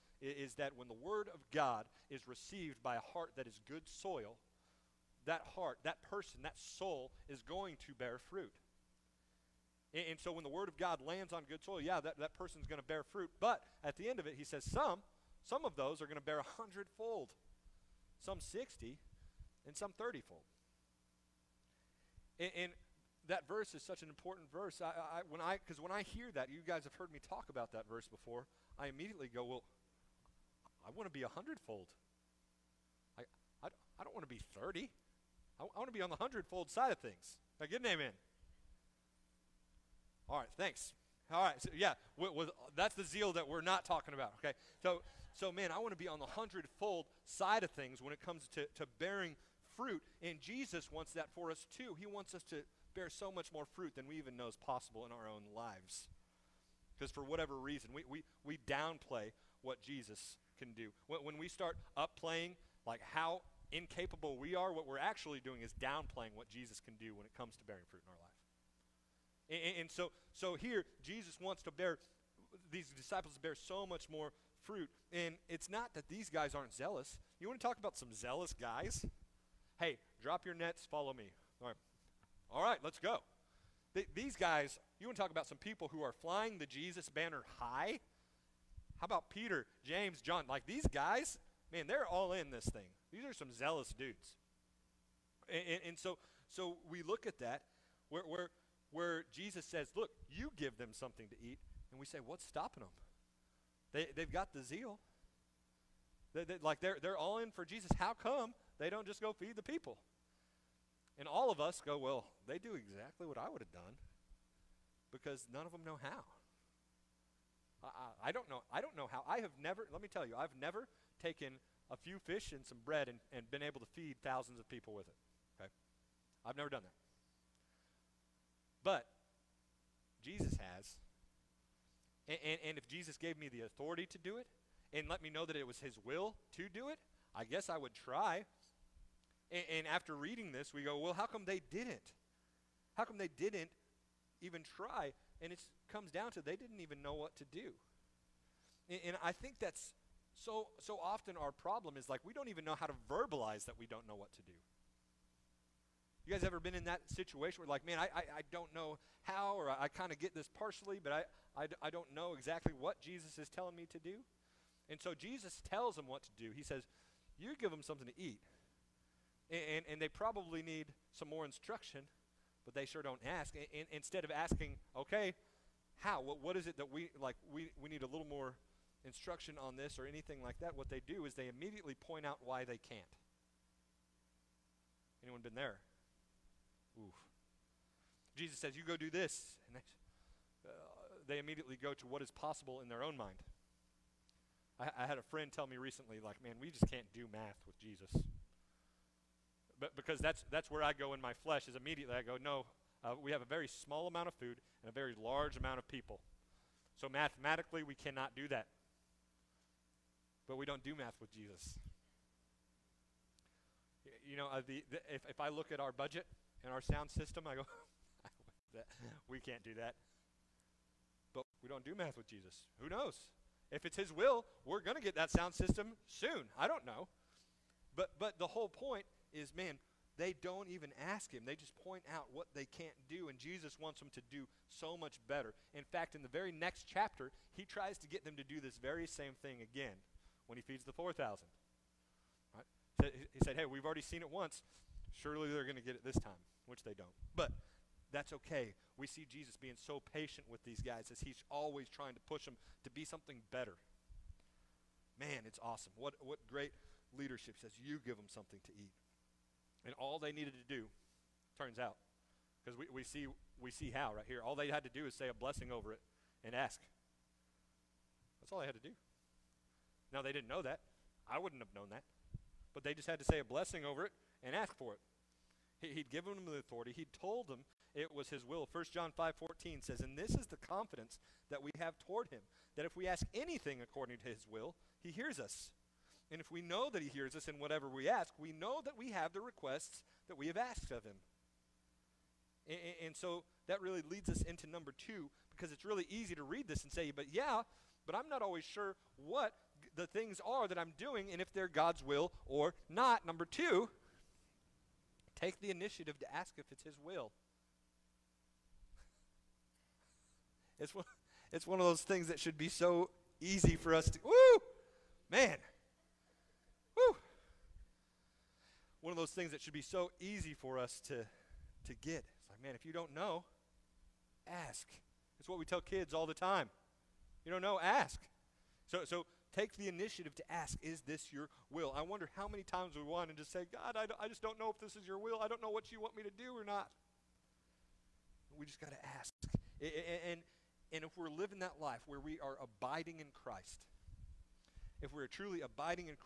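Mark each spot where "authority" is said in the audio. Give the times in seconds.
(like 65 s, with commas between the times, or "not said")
133 s, 276 s.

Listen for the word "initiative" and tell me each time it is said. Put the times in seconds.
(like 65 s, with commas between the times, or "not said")
305 s, 329 s.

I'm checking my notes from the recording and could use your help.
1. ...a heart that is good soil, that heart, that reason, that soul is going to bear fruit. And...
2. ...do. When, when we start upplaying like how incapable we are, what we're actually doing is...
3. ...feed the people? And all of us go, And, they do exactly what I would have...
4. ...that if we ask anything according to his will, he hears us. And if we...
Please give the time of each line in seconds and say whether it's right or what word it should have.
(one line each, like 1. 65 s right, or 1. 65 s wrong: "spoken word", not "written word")
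1. 2 s wrong: "person", not "reason"
2. 60 s right
3. 109 s wrong: "Well", not "And"
4. 282 s right.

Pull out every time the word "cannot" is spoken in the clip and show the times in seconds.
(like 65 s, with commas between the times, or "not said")
207 s.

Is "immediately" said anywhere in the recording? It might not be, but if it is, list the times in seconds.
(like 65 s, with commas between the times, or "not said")
28 s, 181 s, 191 s, 201 s.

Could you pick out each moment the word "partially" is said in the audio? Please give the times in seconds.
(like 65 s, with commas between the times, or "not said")
160 s.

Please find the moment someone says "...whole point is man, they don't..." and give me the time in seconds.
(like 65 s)
228 s.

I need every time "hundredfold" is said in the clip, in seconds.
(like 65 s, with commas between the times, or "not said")
16 s, 31 s, 36 s, 46 s.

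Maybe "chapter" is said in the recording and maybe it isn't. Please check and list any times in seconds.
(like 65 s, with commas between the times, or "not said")
236 s.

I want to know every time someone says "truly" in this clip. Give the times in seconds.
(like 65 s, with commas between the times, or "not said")
345 s.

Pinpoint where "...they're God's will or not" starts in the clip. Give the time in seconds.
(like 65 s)
301 s.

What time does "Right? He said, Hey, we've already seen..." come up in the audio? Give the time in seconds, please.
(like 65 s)
242 s.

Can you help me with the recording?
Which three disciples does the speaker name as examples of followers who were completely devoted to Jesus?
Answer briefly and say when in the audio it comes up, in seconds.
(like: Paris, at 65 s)
Peter, James, John, at 89 s.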